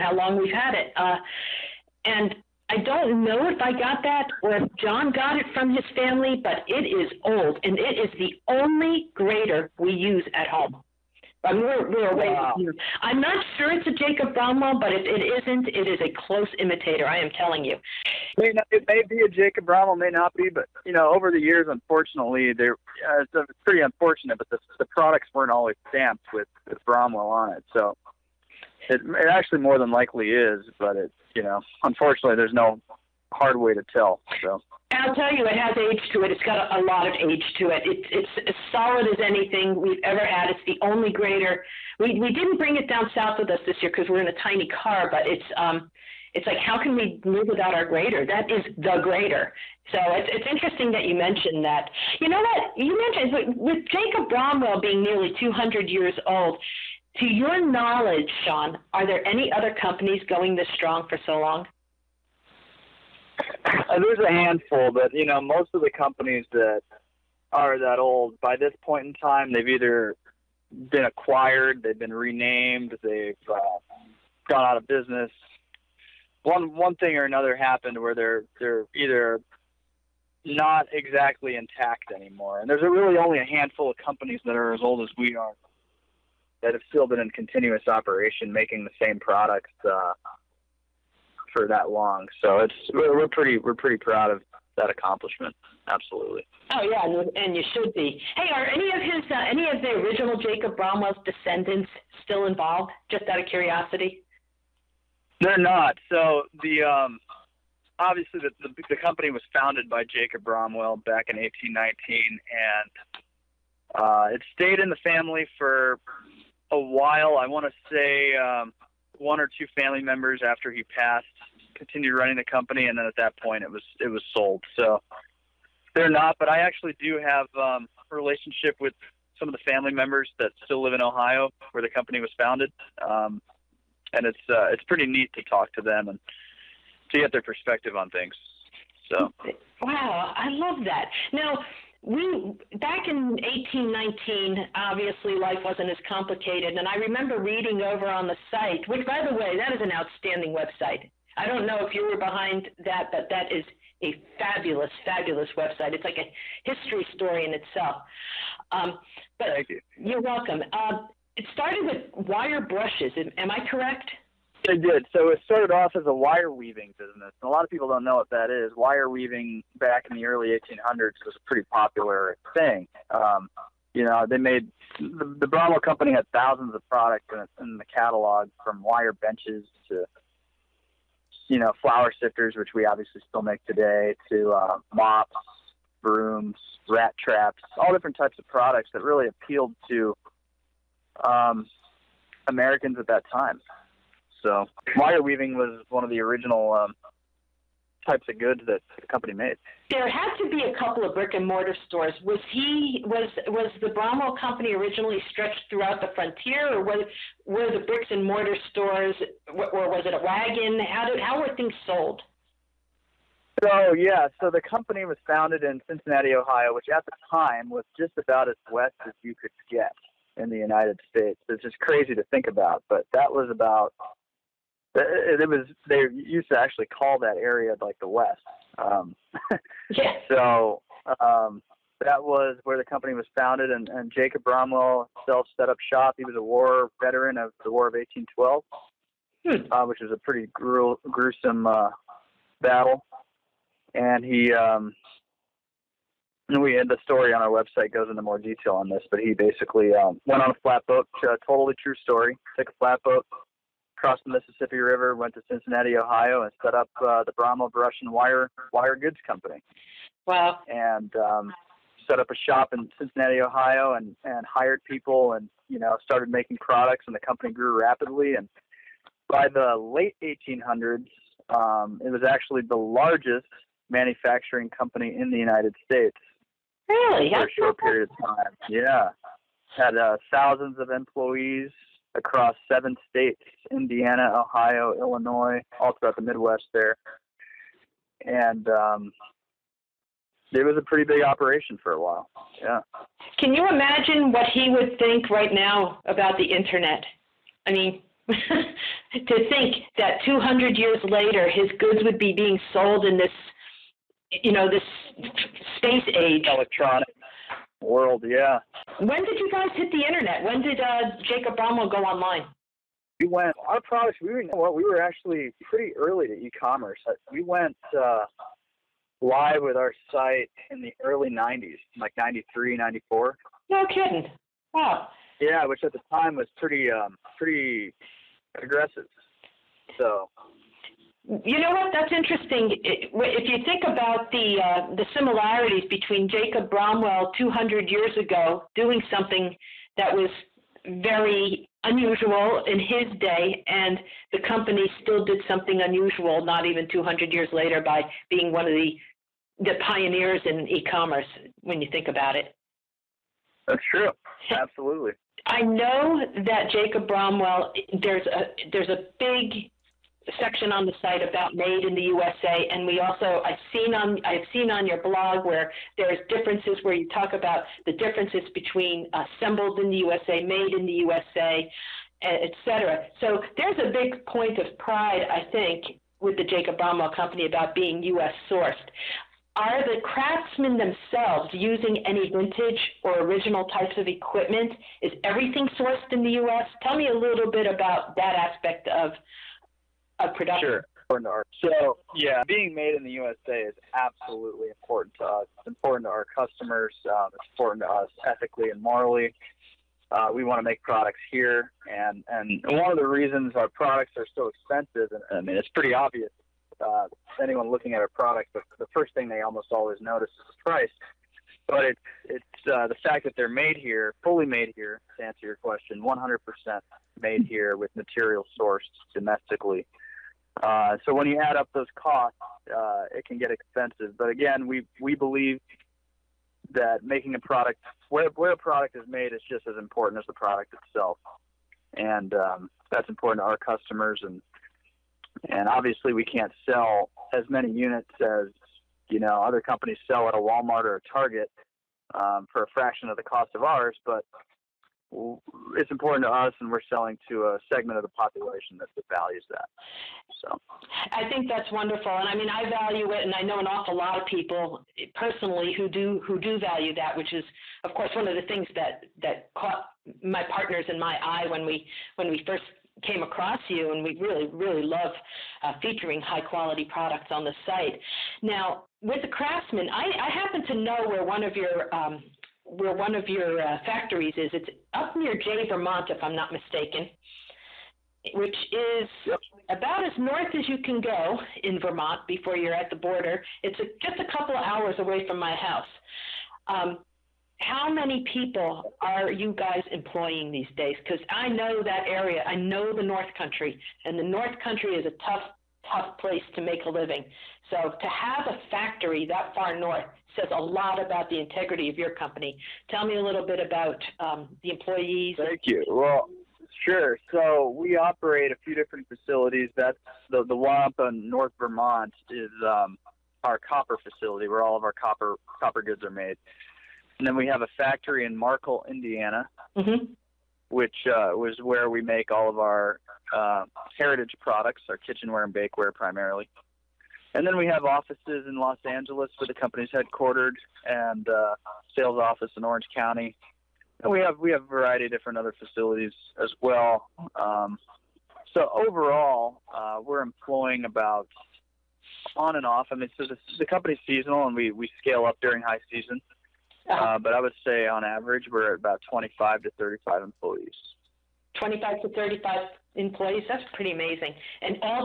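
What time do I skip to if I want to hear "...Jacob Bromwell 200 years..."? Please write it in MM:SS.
05:36.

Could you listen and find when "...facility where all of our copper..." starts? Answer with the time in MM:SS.
08:33.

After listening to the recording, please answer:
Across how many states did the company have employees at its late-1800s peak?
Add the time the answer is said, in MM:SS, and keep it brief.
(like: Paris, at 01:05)
7, at 04:42.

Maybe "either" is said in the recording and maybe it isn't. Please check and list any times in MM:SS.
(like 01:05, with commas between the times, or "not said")
01:09, 01:18.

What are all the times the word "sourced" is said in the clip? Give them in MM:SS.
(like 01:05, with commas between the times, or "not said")
06:18, 06:25, 06:58.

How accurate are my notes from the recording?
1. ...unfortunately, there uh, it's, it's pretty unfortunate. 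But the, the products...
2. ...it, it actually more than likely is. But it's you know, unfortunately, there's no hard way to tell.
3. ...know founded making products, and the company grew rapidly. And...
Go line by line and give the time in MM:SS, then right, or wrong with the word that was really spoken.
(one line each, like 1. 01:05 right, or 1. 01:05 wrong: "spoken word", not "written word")
1. 00:21 right
2. 00:28 right
3. 04:25 wrong: "started", not "founded".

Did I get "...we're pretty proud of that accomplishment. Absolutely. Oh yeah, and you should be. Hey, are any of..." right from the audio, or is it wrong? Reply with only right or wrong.
right.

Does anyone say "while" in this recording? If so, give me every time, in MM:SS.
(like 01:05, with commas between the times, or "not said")
01:56, 04:52.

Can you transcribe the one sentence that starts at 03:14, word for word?
So wire weaving was one of the original um, types of goods that the company made.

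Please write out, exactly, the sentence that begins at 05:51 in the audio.
When you think about it, that's true.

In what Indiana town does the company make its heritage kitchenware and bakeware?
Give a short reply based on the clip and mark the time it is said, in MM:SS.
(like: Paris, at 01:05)
Markle, at 08:38.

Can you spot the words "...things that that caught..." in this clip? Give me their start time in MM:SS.
07:38.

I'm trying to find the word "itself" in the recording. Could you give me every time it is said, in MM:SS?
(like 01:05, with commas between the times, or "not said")
02:37, 07:10.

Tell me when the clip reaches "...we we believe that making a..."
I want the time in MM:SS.
07:04.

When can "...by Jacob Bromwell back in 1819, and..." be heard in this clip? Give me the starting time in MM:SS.
01:49.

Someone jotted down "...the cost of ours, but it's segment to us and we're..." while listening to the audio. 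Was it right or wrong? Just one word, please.
wrong.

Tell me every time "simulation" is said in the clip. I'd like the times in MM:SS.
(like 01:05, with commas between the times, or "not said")
not said.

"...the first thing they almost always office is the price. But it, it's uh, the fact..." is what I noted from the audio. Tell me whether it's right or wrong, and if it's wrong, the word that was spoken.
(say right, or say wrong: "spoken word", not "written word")
wrong: "notice", not "office".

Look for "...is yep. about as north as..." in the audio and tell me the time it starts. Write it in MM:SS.
07:58.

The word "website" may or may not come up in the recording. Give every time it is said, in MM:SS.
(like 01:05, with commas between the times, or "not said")
02:30, 02:35, 04:07.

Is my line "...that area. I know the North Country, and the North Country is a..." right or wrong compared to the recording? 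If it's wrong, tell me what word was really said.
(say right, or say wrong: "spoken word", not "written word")
right.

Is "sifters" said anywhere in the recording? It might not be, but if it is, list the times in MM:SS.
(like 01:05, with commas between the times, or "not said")
03:02.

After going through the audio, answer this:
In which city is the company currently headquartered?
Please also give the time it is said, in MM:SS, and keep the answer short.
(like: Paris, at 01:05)
Los Angeles, at 08:48.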